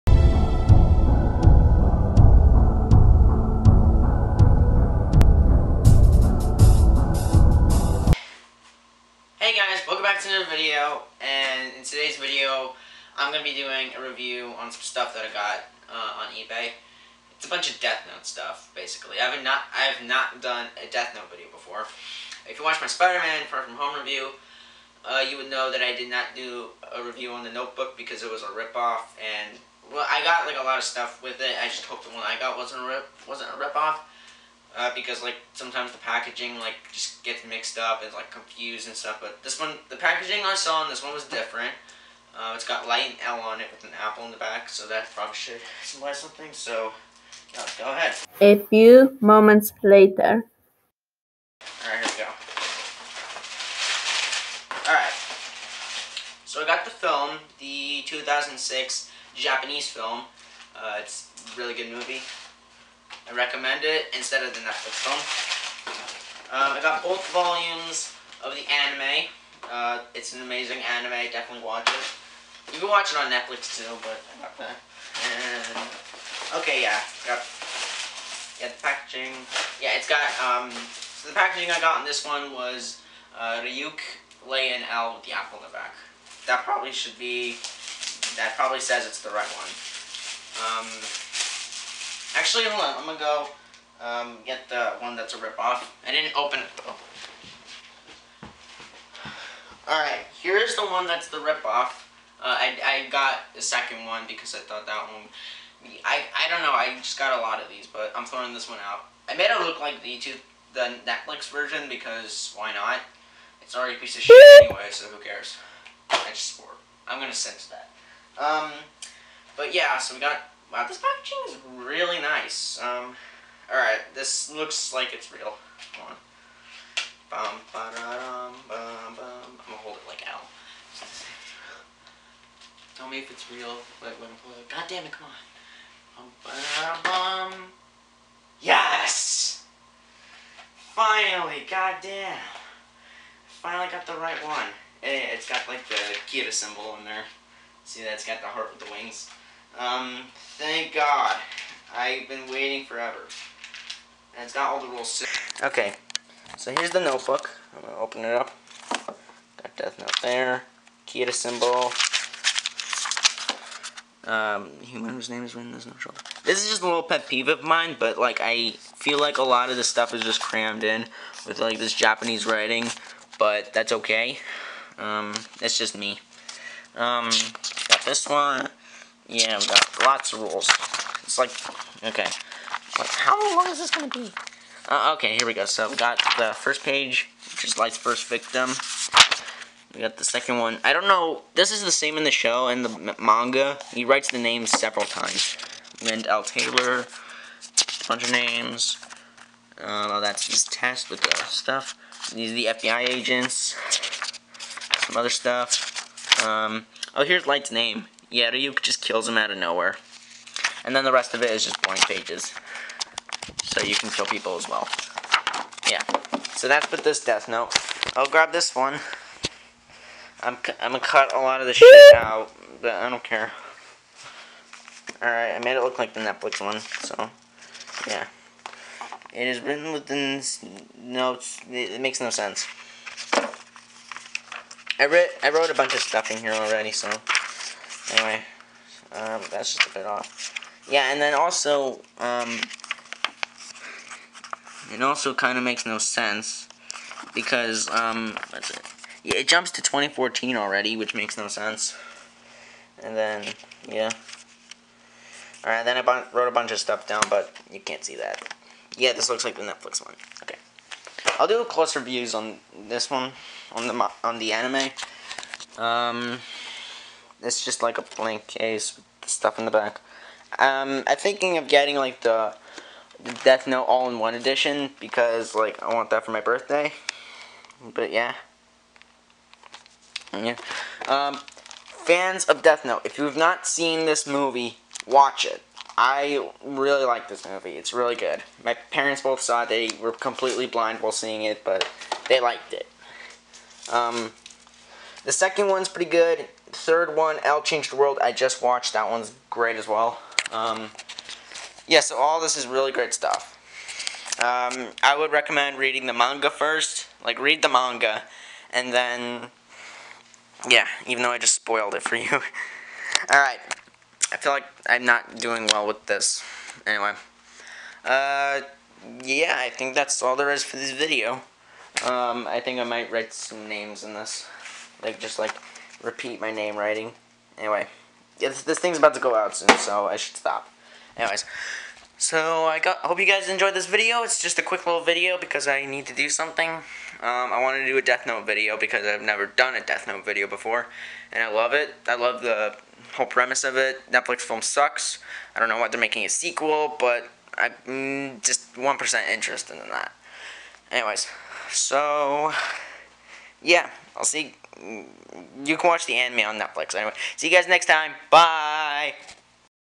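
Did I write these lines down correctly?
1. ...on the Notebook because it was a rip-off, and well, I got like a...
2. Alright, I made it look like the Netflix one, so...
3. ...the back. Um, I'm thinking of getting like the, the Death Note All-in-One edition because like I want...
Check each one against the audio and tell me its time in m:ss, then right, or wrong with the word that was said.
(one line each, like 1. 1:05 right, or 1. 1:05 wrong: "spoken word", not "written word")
1. 0:27 right
2. 3:45 right
3. 4:29 right.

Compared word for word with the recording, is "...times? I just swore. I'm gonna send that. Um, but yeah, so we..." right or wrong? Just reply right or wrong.
wrong.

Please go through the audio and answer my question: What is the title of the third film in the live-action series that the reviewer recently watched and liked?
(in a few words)
L Changed the World.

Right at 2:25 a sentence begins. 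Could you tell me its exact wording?
Eh, it, has got like the Kira symbol in there.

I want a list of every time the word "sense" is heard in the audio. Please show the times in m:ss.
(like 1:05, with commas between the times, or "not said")
3:52, 4:05, 4:11.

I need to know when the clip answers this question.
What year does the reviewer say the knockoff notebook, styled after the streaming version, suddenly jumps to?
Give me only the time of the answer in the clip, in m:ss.
4:09.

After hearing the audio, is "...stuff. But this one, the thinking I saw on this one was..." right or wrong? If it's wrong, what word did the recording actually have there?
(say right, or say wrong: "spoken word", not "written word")
wrong: "packaging", not "thinking".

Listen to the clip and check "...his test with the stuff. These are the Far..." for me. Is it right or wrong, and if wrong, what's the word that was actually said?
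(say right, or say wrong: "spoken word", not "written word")
wrong: "FBI", not "Far".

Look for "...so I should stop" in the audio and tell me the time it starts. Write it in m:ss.
5:29.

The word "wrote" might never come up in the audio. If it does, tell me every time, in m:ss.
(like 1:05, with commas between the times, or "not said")
3:55, 4:16.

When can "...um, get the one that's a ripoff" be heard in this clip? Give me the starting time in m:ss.
1:34.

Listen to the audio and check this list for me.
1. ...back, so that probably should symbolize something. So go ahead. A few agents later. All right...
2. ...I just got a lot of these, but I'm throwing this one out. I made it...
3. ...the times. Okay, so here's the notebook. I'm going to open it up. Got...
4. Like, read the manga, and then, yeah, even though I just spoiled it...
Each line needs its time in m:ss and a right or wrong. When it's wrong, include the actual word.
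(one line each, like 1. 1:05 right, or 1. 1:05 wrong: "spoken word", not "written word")
1. 0:44 wrong: "moments", not "agents"
2. 1:46 right
3. 2:34 wrong: "rules", not "times"
4. 5:07 right.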